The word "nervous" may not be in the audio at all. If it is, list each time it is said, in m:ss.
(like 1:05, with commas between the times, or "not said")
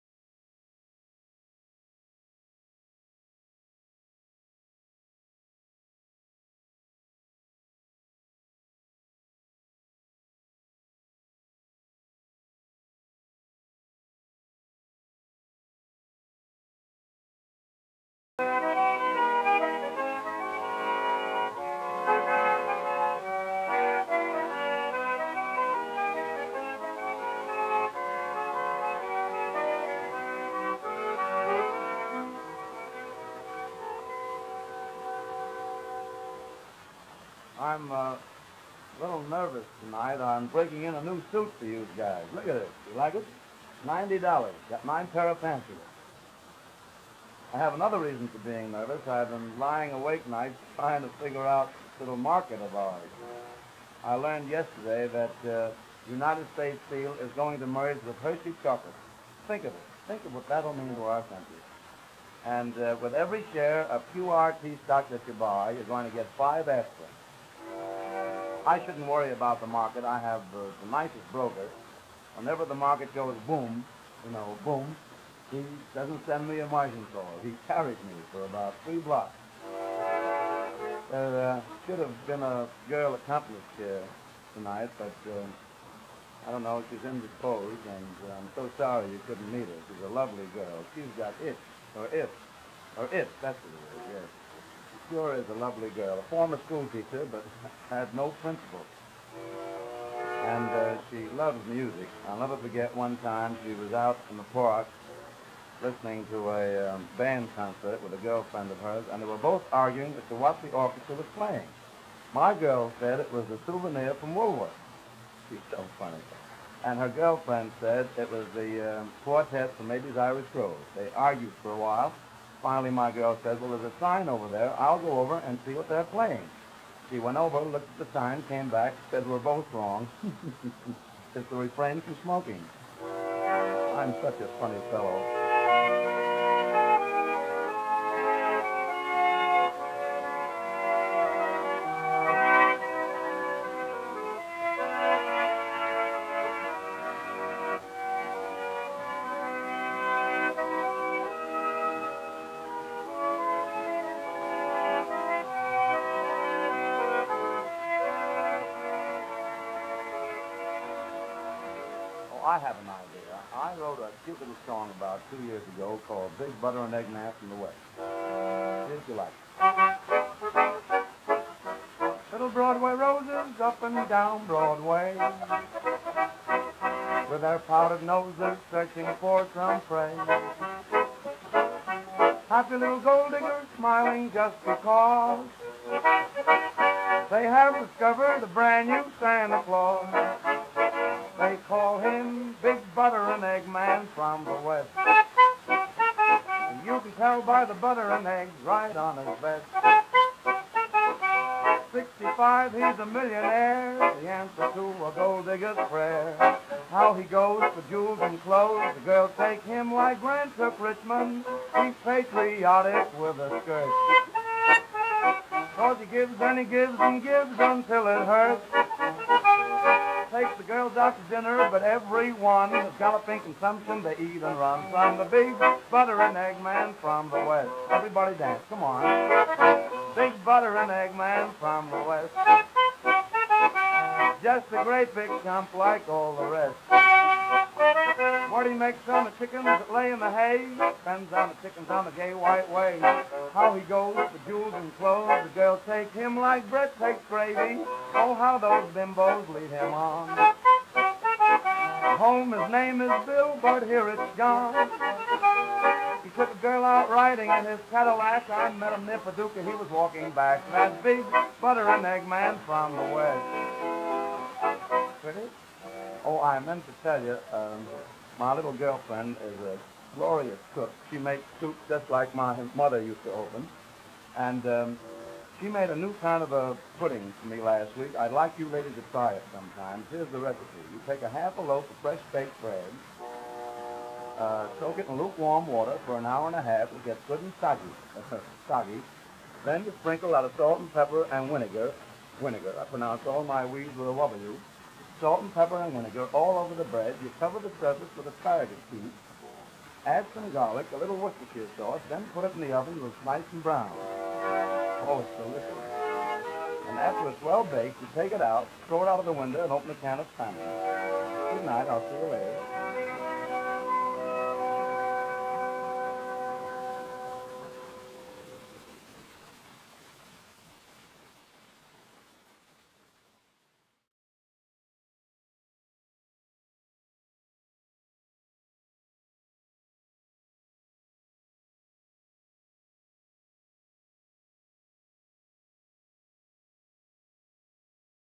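0:39, 0:48.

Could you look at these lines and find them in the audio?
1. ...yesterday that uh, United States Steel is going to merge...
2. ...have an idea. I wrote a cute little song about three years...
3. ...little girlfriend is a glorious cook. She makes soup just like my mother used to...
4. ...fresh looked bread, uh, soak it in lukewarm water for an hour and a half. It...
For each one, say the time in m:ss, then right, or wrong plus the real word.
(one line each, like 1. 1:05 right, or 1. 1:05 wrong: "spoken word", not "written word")
1. 0:54 right
2. 2:42 wrong: "two", not "three"
3. 4:28 right
4. 4:41 wrong: "baked", not "looked".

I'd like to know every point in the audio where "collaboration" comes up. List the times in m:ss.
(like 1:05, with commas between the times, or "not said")
not said.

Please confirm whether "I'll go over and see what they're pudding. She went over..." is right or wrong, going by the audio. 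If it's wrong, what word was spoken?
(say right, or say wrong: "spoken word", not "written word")
wrong: "playing", not "pudding".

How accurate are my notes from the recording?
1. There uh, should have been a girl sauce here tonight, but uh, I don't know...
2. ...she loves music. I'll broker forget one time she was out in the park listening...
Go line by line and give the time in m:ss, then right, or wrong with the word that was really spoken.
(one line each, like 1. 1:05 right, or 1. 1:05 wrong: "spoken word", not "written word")
1. 1:21 wrong: "accomplice", not "sauce"
2. 1:41 wrong: "never", not "broker".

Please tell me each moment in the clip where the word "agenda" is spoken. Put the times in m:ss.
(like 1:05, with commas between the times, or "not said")
not said.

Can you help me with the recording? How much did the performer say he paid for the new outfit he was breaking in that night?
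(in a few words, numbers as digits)
$90.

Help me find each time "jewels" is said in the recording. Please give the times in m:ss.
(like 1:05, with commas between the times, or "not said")
3:27, 4:04.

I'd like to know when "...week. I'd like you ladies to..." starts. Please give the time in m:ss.
4:37.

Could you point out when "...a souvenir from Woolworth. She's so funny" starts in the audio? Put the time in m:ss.
1:53.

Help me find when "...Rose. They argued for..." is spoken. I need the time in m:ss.
2:00.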